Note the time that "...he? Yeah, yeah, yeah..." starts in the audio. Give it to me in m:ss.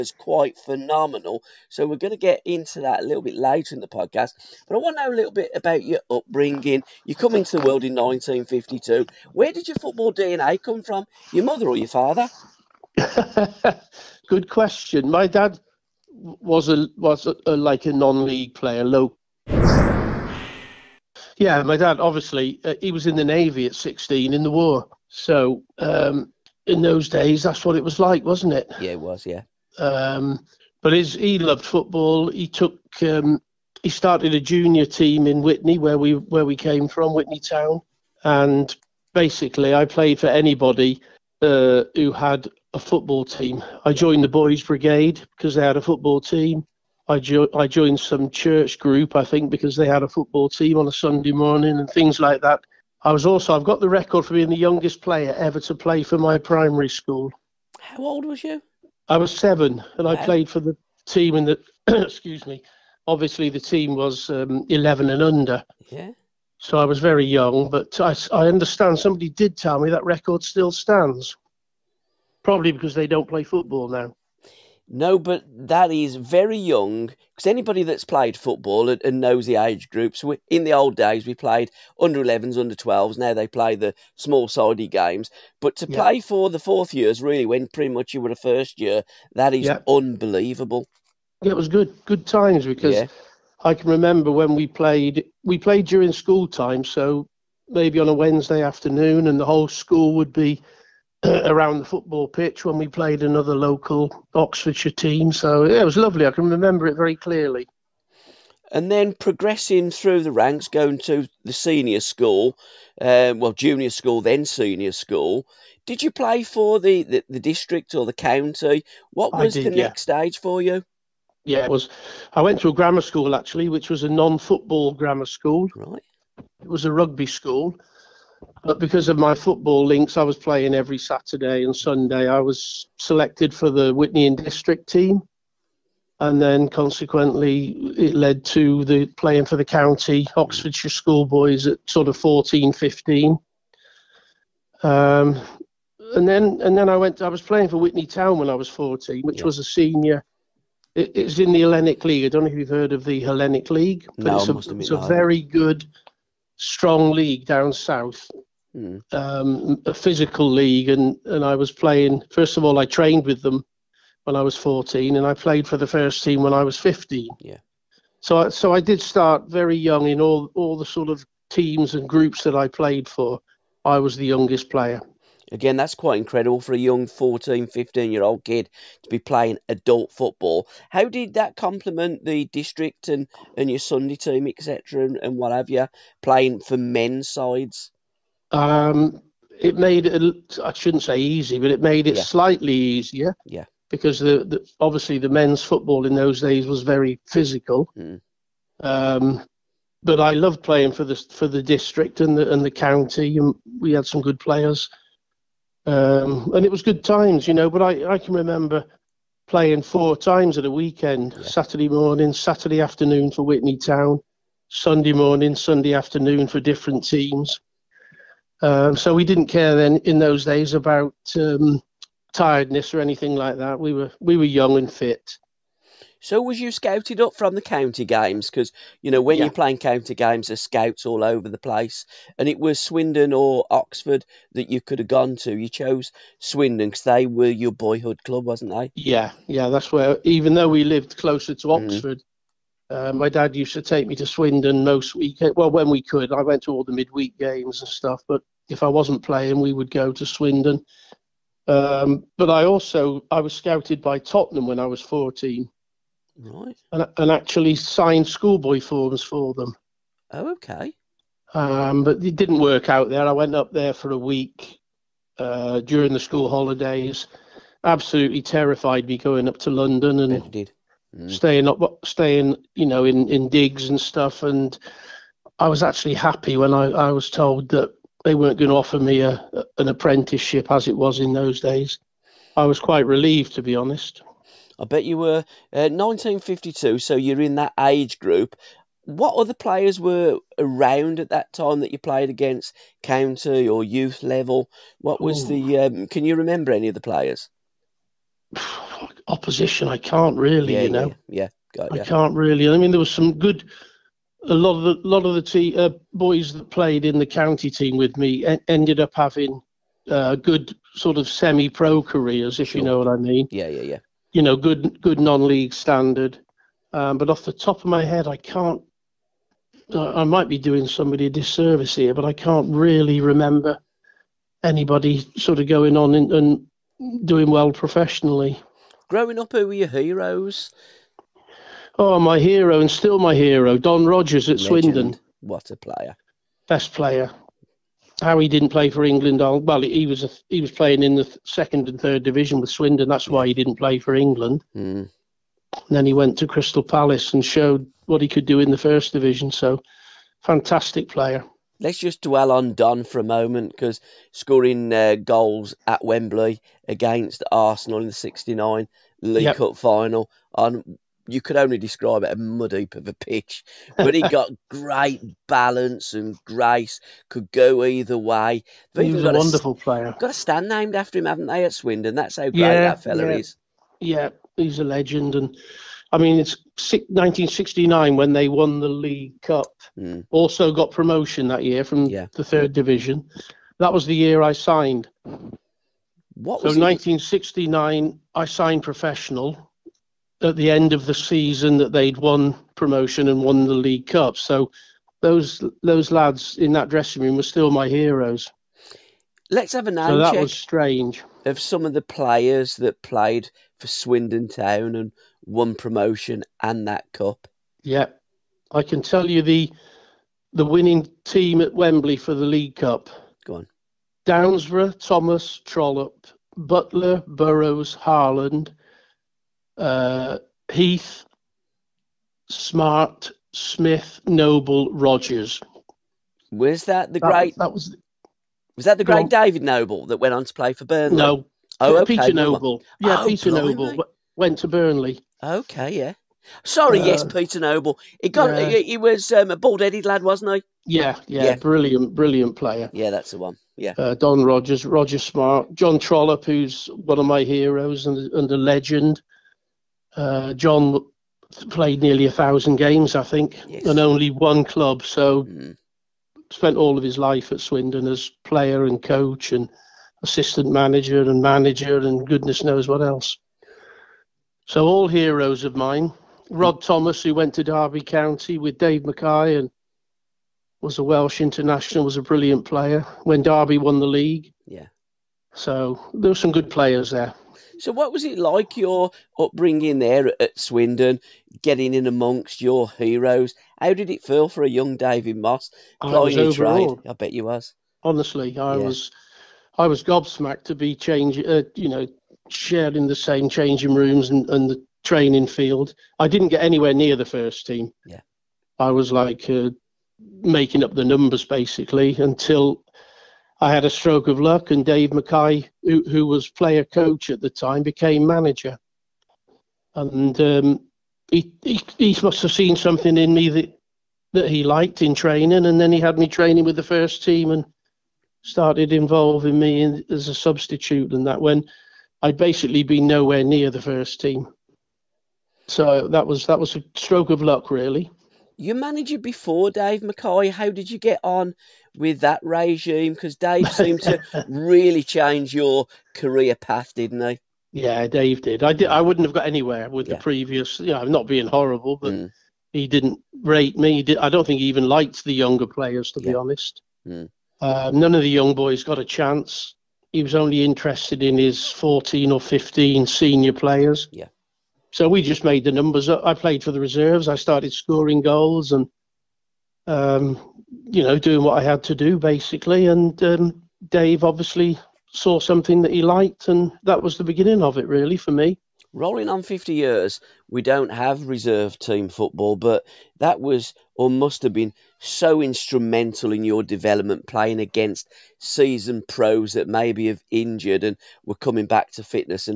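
7:20.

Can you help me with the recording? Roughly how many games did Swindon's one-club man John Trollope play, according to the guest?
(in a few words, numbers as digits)
nearly 1000.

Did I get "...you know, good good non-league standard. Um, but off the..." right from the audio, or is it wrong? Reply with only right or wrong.
right.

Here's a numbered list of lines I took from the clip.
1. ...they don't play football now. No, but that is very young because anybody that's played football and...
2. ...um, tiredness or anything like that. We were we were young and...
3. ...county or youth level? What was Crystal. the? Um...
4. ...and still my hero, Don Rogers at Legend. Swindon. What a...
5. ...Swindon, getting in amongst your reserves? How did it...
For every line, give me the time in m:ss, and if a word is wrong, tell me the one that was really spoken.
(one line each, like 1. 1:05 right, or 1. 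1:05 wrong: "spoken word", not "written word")
1. 1:12 right
2. 3:41 right
3. 4:53 wrong: "Ooh", not "Crystal"
4. 5:32 right
5. 8:00 wrong: "heroes", not "reserves".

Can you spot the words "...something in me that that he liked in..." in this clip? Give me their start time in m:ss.
8:32.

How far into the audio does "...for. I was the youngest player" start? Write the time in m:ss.
2:53.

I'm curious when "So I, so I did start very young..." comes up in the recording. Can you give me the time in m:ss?
2:48.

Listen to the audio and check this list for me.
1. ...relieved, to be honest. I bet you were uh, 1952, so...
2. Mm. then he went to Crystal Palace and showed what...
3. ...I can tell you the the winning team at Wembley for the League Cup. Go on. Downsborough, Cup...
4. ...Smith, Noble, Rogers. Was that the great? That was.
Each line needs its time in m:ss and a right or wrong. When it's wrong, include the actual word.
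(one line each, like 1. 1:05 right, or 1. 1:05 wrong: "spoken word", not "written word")
1. 4:43 right
2. 5:44 right
3. 6:48 wrong: "Thomas", not "Cup"
4. 7:03 right.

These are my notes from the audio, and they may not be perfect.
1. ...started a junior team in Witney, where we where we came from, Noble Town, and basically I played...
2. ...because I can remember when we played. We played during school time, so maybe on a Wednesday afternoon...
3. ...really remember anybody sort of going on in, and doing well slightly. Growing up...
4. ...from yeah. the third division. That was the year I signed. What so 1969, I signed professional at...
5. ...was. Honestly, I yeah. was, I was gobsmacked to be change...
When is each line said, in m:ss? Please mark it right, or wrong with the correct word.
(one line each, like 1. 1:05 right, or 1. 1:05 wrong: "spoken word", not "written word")
1. 0:33 wrong: "Witney", not "Noble"
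2. 1:32 right
3. 5:22 wrong: "professionally", not "slightly"
4. 6:21 right
5. 8:07 right.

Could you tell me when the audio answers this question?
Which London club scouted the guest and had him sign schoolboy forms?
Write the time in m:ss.
4:14.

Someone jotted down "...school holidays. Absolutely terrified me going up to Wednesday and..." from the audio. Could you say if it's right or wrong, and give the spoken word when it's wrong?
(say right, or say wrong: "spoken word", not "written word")
wrong: "London", not "Wednesday".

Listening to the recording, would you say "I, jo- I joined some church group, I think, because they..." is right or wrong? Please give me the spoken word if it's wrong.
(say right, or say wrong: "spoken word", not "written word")
right.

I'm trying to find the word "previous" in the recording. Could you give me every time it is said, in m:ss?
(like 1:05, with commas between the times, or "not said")
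9:00.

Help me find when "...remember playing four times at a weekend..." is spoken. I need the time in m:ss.
3:28.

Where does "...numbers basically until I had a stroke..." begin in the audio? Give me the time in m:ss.
8:21.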